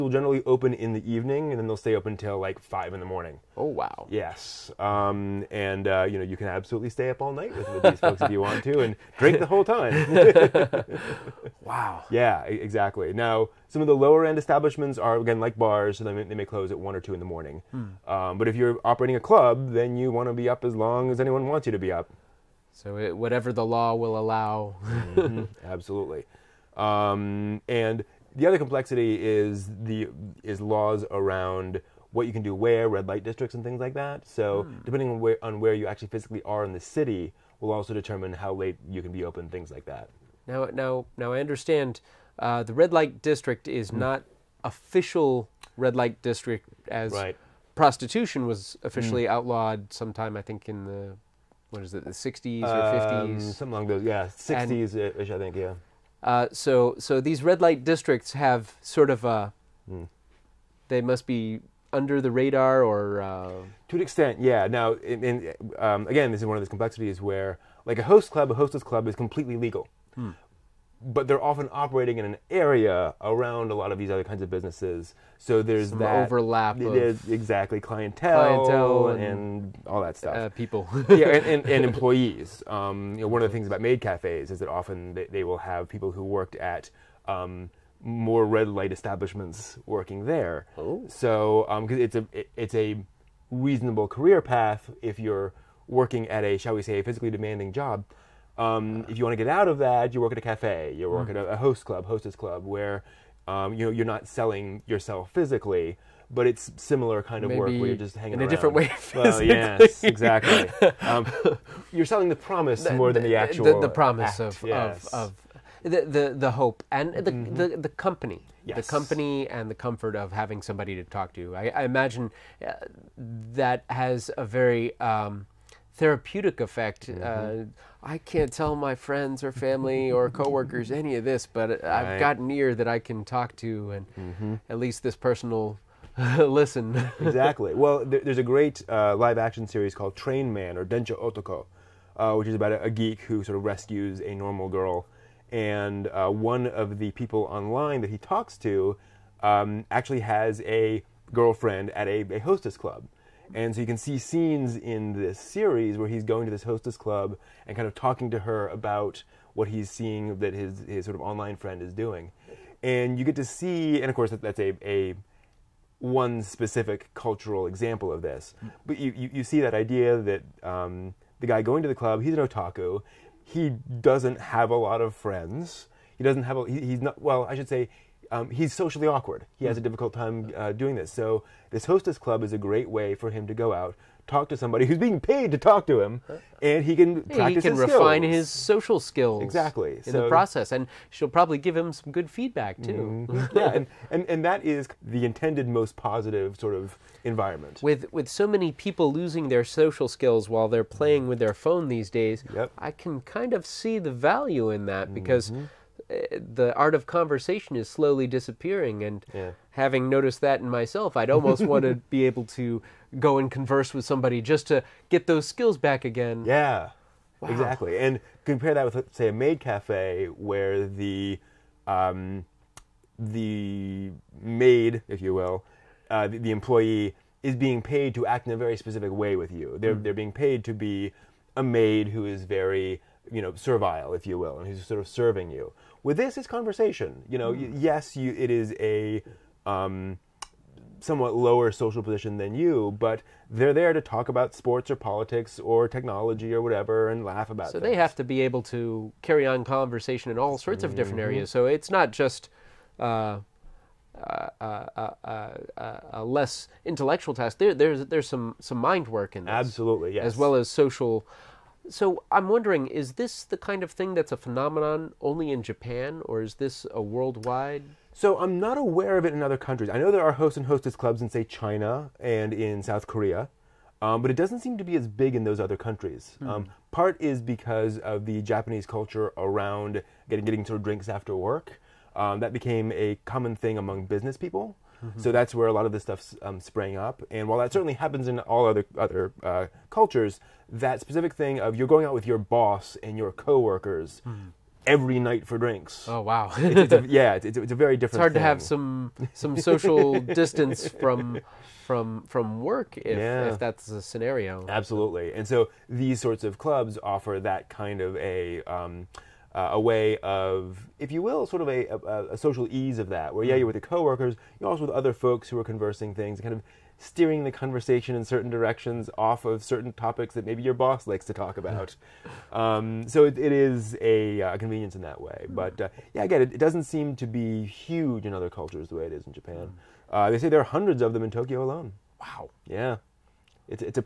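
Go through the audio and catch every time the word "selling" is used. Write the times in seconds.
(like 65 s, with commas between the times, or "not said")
104 s, 112 s.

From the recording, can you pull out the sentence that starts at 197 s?
With with so many people losing their social skills while they're playing mm.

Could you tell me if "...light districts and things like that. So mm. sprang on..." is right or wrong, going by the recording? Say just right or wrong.
wrong.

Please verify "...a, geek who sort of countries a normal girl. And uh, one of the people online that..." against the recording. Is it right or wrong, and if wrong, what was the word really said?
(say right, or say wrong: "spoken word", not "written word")
wrong: "rescues", not "countries".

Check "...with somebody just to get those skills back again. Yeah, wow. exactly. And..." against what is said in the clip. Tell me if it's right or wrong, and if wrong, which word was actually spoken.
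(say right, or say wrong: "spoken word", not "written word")
right.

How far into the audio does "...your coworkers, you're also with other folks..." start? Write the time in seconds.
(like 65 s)
313 s.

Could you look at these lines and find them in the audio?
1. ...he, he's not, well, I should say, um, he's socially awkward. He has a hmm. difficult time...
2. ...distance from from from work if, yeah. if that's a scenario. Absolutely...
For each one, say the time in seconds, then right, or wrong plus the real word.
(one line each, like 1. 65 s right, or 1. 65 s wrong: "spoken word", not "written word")
1. 176 s right
2. 300 s right.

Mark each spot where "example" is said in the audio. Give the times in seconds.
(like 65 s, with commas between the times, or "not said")
167 s.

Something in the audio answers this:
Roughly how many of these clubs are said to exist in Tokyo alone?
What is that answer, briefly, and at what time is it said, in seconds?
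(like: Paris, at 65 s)
hundreds, at 330 s.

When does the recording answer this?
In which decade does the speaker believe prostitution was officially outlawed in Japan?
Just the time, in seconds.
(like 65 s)
54 s.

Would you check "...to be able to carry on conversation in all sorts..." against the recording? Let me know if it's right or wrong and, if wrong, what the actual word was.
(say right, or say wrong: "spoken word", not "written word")
right.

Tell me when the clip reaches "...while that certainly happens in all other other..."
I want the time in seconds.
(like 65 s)
287 s.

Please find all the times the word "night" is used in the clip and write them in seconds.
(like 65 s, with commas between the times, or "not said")
7 s, 295 s.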